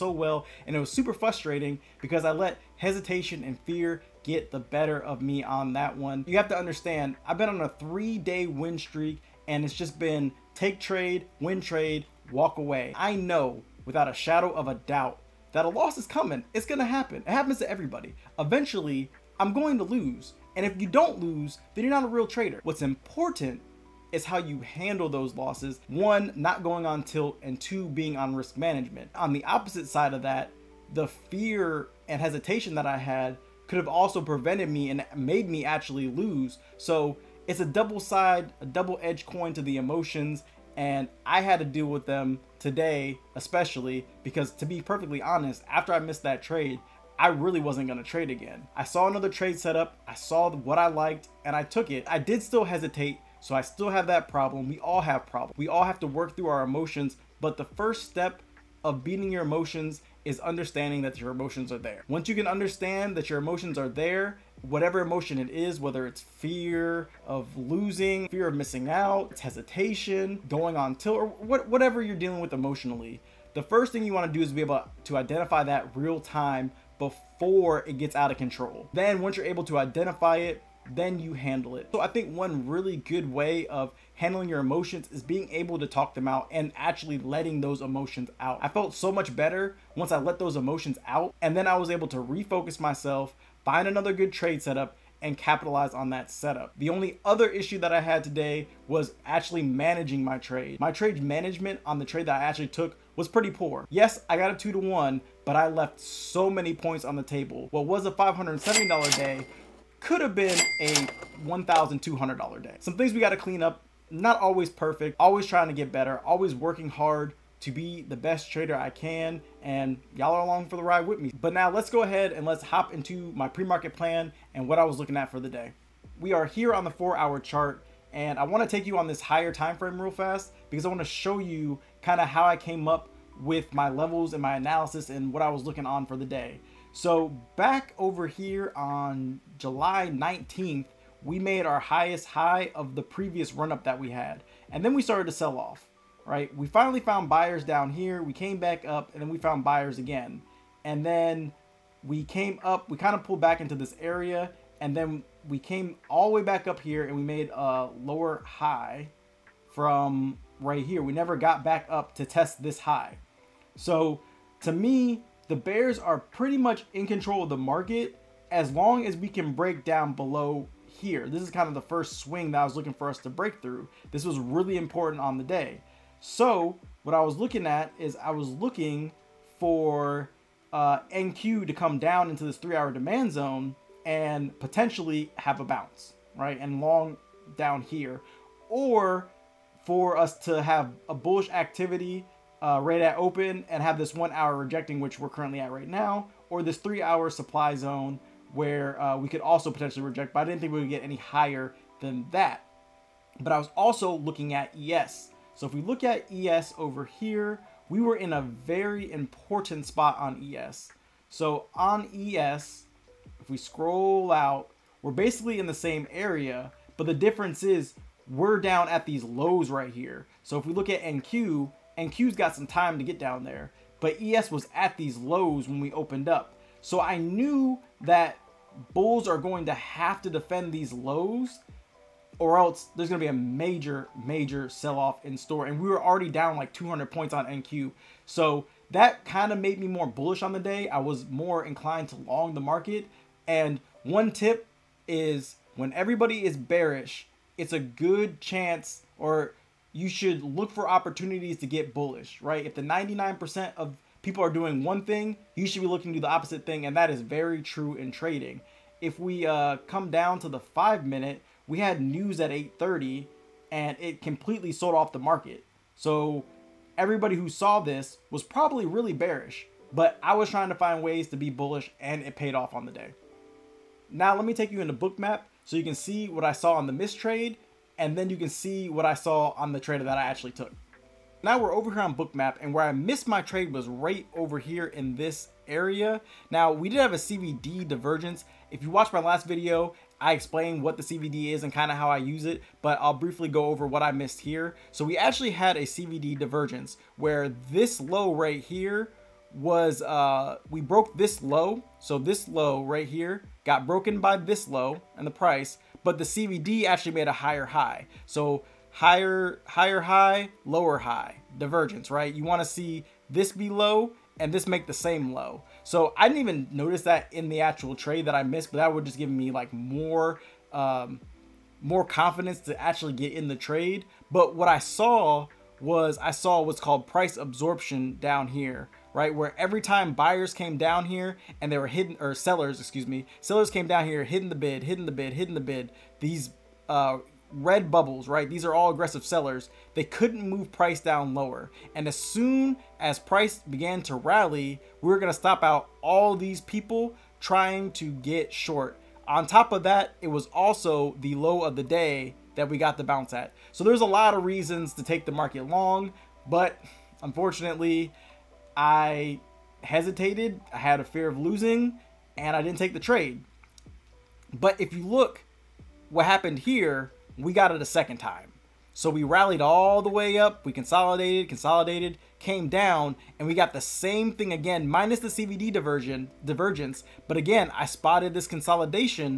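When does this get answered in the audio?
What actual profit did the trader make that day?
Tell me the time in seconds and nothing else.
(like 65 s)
108 s.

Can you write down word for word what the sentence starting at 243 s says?
And one tip is when everybody is bearish, it's a good chance or you should look for opportunities to get bullish, right?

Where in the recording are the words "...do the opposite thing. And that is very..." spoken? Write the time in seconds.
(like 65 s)
256 s.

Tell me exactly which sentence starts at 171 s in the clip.
This is kind of the first swing that I was looking for us to break through.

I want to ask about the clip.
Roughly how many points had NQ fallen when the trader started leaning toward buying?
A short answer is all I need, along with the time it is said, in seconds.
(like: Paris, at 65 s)
200 points, at 236 s.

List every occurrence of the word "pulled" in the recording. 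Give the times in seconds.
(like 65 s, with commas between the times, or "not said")
153 s.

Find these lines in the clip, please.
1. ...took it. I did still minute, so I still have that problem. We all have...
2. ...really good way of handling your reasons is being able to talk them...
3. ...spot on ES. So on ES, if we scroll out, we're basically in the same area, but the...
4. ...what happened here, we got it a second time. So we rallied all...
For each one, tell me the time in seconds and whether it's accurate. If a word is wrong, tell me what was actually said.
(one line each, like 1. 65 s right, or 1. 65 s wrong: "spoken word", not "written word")
1. 51 s wrong: "hesitate", not "minute"
2. 82 s wrong: "emotions", not "reasons"
3. 209 s right
4. 366 s right.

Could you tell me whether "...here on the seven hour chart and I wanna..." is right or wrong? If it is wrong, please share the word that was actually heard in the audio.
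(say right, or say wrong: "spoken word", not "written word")
wrong: "four", not "seven".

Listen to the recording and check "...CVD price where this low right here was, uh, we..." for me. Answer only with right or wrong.
wrong.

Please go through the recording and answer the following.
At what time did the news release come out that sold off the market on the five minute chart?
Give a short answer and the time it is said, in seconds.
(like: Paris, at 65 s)
8:30, at 262 s.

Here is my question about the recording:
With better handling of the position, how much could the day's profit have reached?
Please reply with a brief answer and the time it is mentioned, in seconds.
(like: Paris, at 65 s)
$1,200, at 111 s.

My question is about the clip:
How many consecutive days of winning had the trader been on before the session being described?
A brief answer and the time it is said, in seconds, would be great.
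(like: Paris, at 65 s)
3 days, at 7 s.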